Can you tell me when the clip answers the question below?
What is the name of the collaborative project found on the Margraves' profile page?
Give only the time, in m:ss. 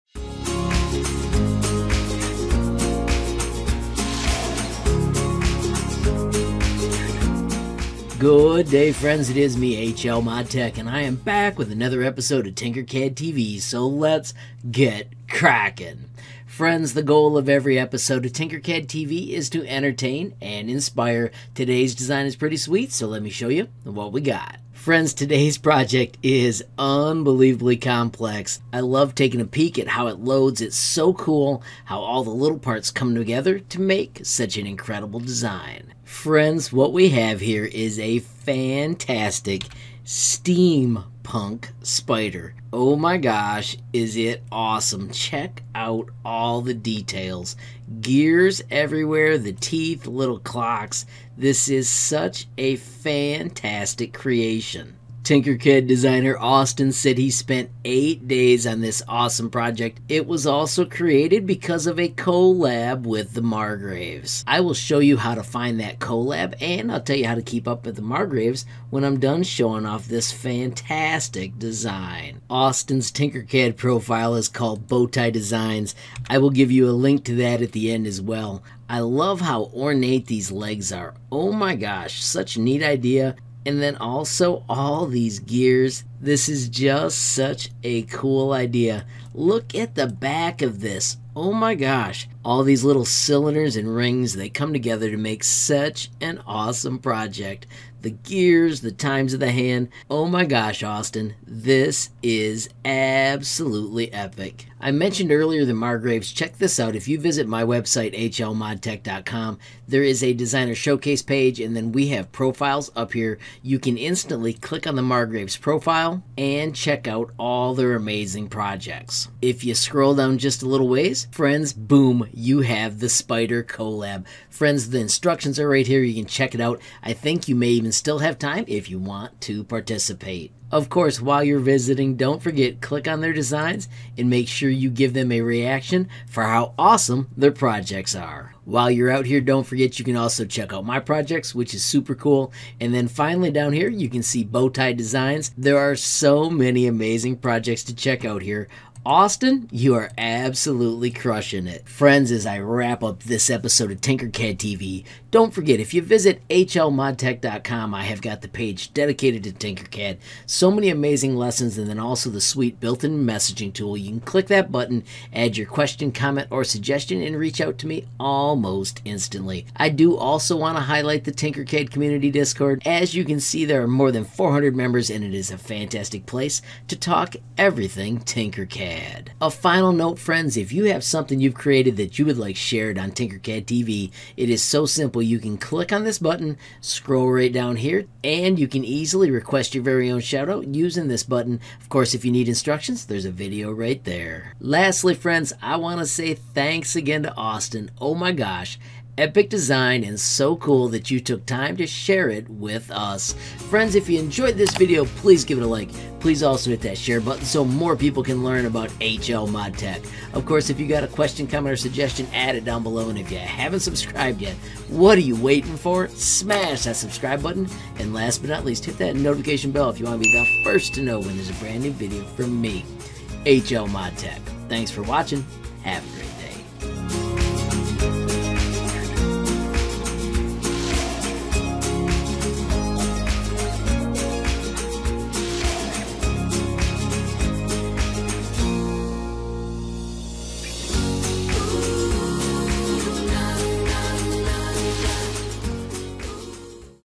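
2:03.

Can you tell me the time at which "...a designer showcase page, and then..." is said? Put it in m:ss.
1:50.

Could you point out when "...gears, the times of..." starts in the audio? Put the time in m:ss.
1:38.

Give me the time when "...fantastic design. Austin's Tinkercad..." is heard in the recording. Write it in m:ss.
1:10.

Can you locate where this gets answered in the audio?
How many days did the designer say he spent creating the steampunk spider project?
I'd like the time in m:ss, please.
0:57.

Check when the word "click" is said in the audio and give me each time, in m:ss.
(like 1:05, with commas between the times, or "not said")
1:54, 2:12, 2:44, 3:05.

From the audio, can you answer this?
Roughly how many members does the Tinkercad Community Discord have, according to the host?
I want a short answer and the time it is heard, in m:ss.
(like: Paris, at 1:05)
more than 400, at 2:53.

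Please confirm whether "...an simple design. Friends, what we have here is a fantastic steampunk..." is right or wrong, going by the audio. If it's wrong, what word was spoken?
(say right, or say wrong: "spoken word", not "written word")
wrong: "incredible", not "simple".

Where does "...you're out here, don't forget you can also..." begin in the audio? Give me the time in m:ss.
2:18.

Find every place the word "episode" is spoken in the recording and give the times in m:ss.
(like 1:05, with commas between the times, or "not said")
0:12, 0:17, 2:33.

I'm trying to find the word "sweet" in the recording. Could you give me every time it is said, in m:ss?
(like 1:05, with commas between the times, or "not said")
0:22, 2:42.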